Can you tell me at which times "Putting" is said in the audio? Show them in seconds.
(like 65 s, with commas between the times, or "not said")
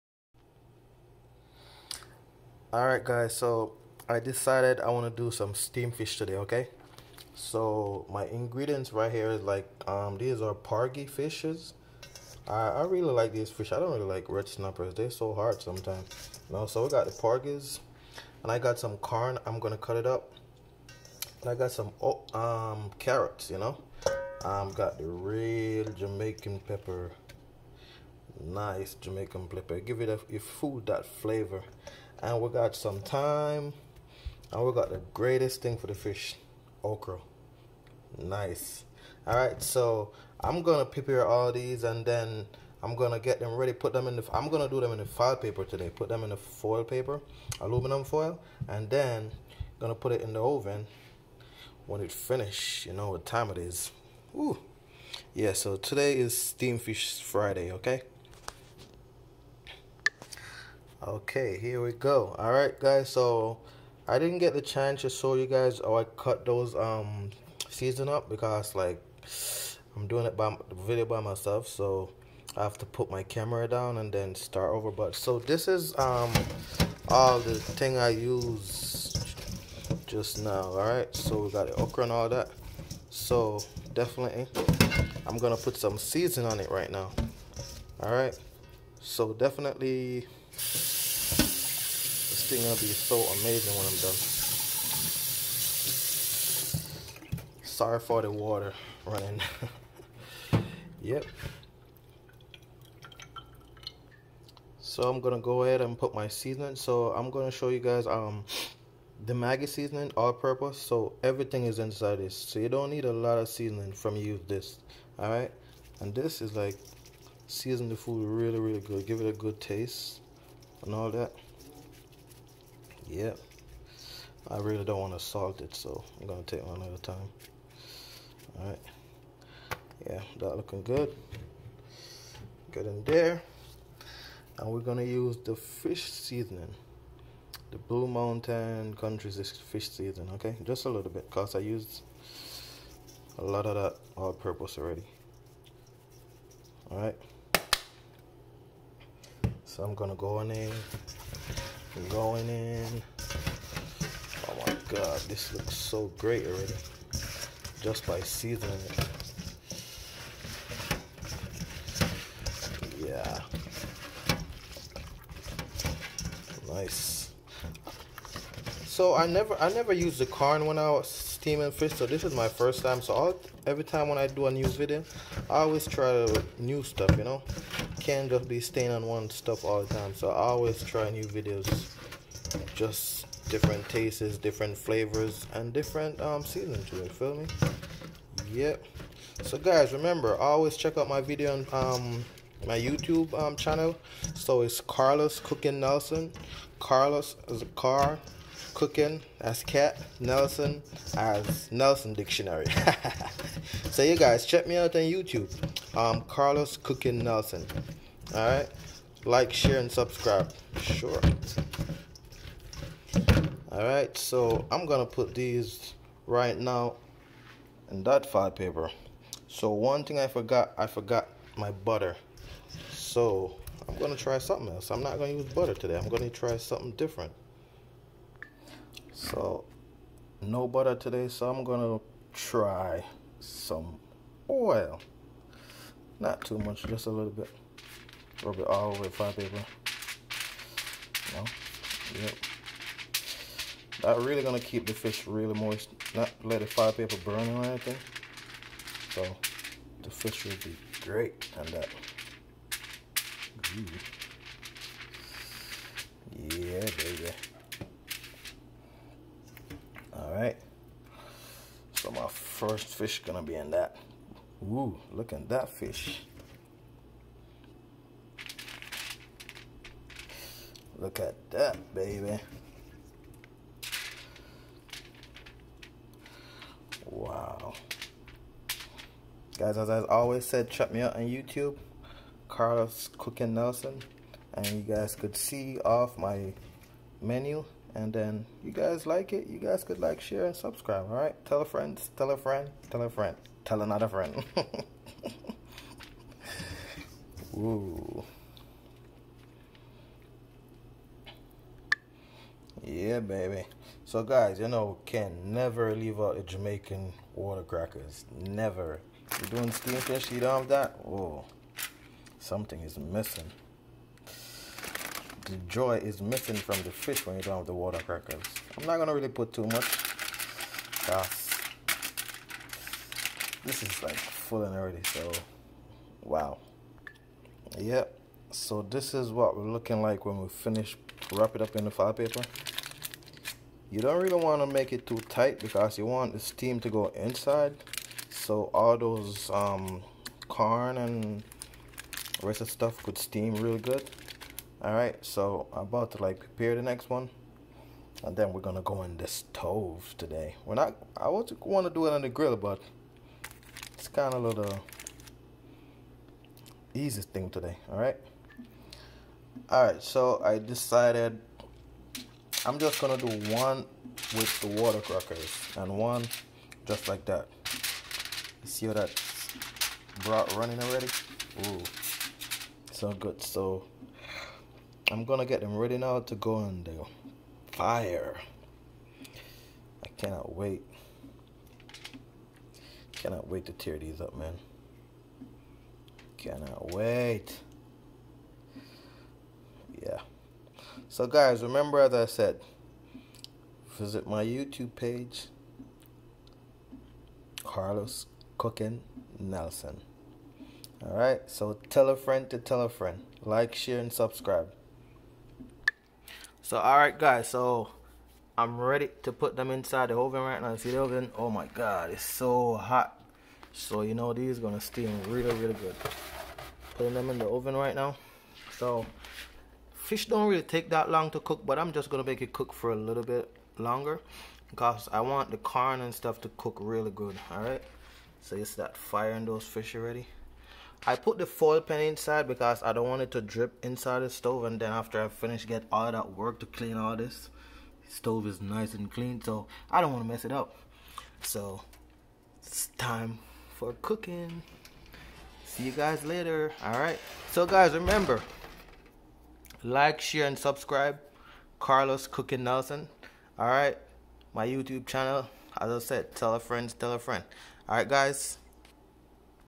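416 s.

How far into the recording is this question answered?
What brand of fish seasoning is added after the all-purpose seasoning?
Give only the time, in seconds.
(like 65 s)
137 s.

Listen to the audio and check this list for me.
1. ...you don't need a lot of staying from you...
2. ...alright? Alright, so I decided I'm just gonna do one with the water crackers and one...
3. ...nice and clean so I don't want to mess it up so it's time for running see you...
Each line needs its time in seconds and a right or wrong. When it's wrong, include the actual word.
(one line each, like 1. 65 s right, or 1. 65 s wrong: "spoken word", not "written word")
1. 112 s wrong: "seasoning", not "staying"
2. 357 s right
3. 438 s wrong: "cooking", not "running".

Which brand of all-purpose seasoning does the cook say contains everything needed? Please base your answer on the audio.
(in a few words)
Maggi.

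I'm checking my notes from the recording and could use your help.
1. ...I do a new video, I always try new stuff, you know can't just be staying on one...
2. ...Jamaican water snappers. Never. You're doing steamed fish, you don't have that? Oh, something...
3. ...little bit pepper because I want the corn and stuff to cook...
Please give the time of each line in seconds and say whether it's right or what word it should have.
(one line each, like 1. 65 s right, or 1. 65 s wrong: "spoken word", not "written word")
1. 174 s right
2. 306 s wrong: "crackers", not "snappers"
3. 422 s wrong: "longer", not "pepper".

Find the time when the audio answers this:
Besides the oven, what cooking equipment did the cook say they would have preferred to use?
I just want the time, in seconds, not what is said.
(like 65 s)
352 s.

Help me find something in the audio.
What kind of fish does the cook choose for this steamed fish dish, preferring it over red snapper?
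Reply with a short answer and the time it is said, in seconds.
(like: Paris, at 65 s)
Porgy, at 17 s.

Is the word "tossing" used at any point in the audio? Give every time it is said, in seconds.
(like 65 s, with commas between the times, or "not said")
not said.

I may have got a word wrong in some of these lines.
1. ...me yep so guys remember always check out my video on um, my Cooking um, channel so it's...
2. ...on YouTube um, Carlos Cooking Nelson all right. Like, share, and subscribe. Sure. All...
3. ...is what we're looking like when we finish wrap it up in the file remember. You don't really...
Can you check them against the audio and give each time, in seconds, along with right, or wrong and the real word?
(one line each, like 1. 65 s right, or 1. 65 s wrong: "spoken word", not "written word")
1. 187 s wrong: "YouTube", not "Cooking"
2. 204 s right
3. 329 s wrong: "paper", not "remember".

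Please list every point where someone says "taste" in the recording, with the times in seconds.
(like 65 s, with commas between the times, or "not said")
119 s, 183 s.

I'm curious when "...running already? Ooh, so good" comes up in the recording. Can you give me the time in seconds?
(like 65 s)
370 s.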